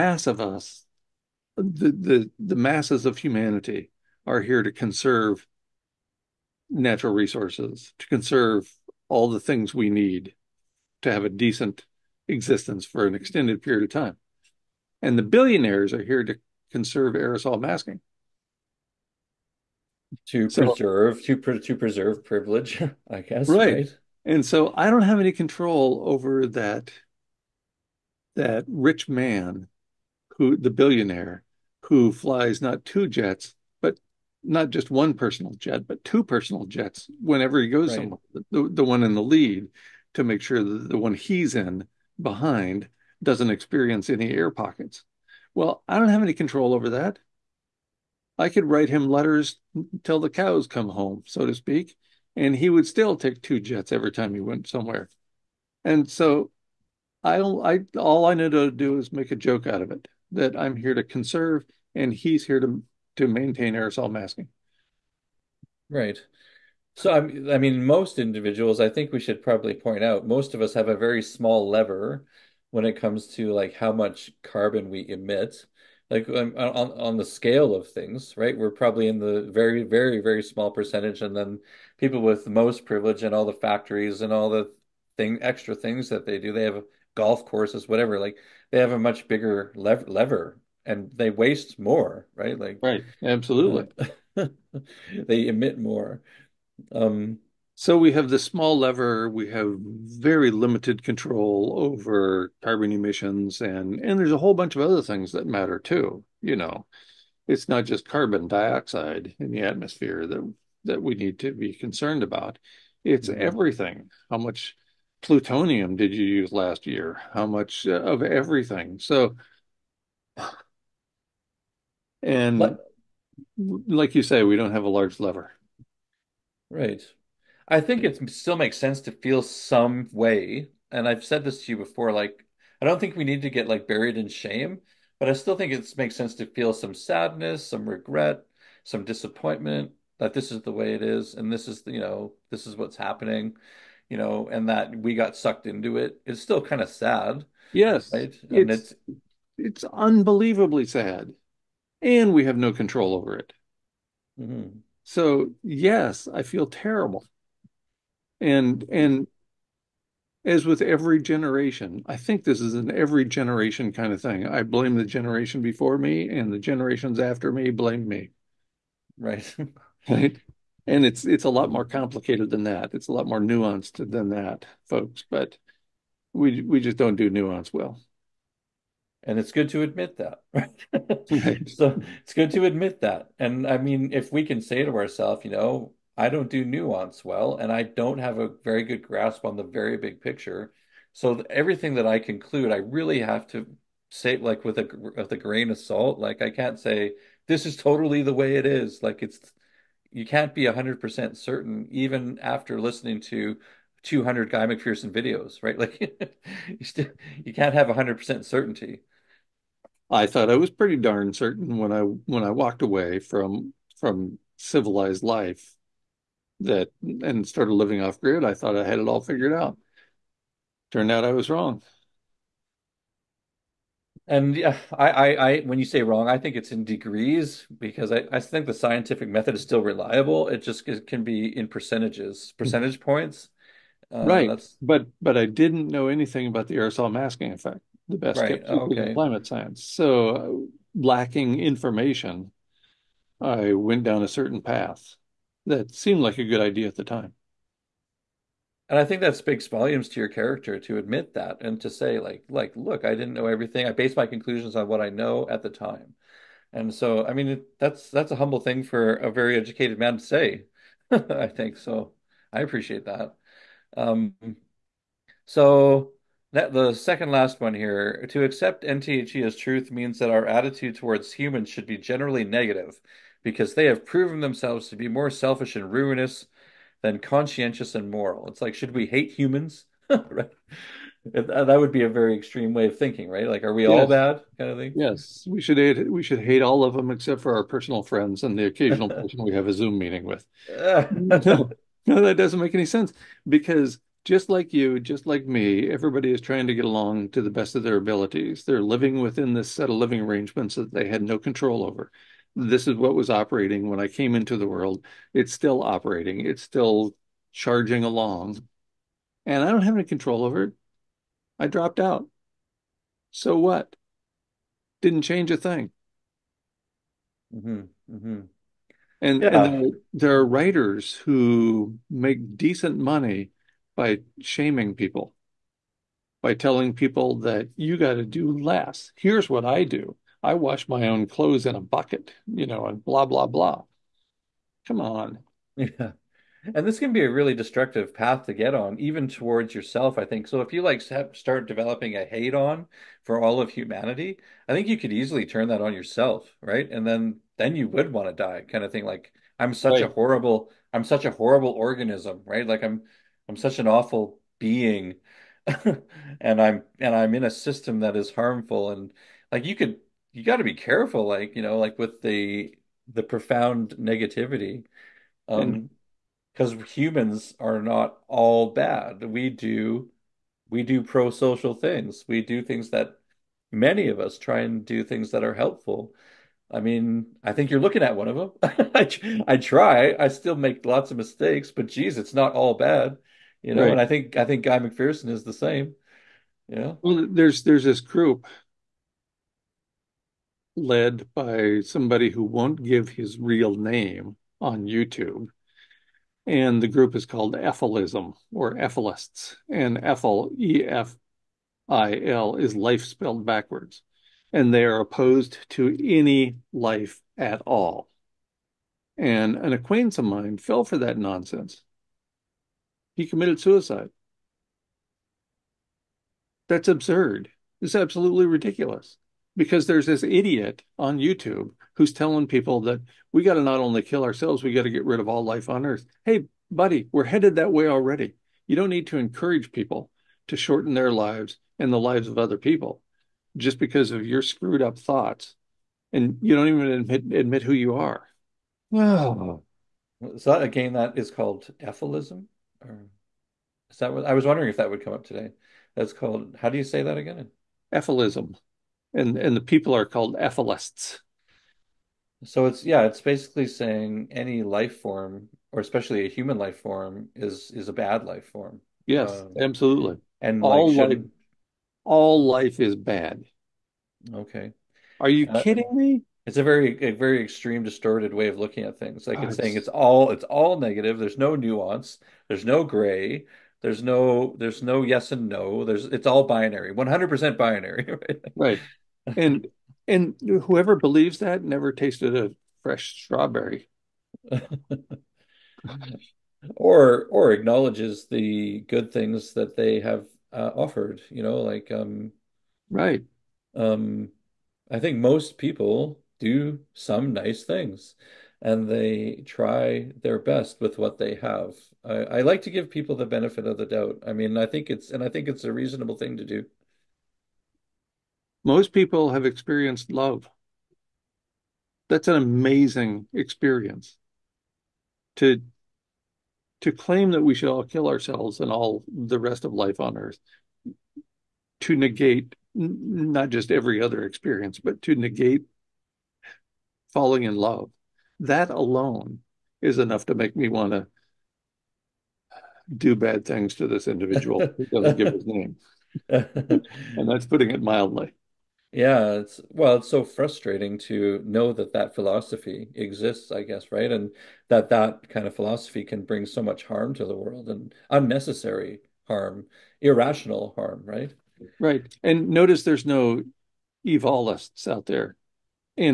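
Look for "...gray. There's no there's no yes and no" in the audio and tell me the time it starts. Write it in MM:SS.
07:52.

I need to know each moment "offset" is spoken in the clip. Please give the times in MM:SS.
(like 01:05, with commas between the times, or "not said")
not said.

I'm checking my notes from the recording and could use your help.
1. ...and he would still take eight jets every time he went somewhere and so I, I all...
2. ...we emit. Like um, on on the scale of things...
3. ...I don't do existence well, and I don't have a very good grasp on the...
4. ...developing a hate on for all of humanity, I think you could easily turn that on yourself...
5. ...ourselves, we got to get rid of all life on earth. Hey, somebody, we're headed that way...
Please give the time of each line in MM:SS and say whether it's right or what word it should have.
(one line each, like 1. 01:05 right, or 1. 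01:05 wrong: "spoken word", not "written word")
1. 00:52 wrong: "two", not "eight"
2. 01:14 right
3. 03:06 wrong: "nuance", not "existence"
4. 05:41 right
5. 07:04 wrong: "buddy", not "somebody".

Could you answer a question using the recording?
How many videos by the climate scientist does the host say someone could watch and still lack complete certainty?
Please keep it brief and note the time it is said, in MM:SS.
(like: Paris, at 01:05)
200, at 03:24.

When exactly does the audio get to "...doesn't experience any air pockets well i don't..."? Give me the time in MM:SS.
00:43.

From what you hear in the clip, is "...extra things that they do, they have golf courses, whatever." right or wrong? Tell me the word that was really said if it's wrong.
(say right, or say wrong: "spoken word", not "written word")
right.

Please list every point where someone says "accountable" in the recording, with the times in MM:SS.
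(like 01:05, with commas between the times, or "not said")
not said.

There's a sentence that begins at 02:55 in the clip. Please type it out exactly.
But we we just don't do nuance well.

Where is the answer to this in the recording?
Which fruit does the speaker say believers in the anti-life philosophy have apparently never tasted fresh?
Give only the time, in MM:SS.
08:03.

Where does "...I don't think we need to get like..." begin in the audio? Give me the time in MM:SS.
02:12.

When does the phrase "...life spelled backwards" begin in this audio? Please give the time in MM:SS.
06:42.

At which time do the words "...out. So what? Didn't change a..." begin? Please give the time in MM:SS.
05:11.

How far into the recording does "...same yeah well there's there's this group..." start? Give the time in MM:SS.
06:25.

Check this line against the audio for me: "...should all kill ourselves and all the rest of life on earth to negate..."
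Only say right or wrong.
right.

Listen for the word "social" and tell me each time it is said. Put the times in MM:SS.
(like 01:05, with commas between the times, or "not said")
06:11.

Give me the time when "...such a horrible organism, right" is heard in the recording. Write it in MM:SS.
05:51.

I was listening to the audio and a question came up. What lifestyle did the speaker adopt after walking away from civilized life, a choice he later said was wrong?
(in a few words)
Living off grid.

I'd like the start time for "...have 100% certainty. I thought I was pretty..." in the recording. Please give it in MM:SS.
03:27.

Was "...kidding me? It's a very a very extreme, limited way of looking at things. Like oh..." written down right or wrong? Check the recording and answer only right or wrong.
wrong.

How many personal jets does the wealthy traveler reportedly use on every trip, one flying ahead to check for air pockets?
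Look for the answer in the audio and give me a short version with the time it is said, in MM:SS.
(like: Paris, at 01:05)
2, at 00:36.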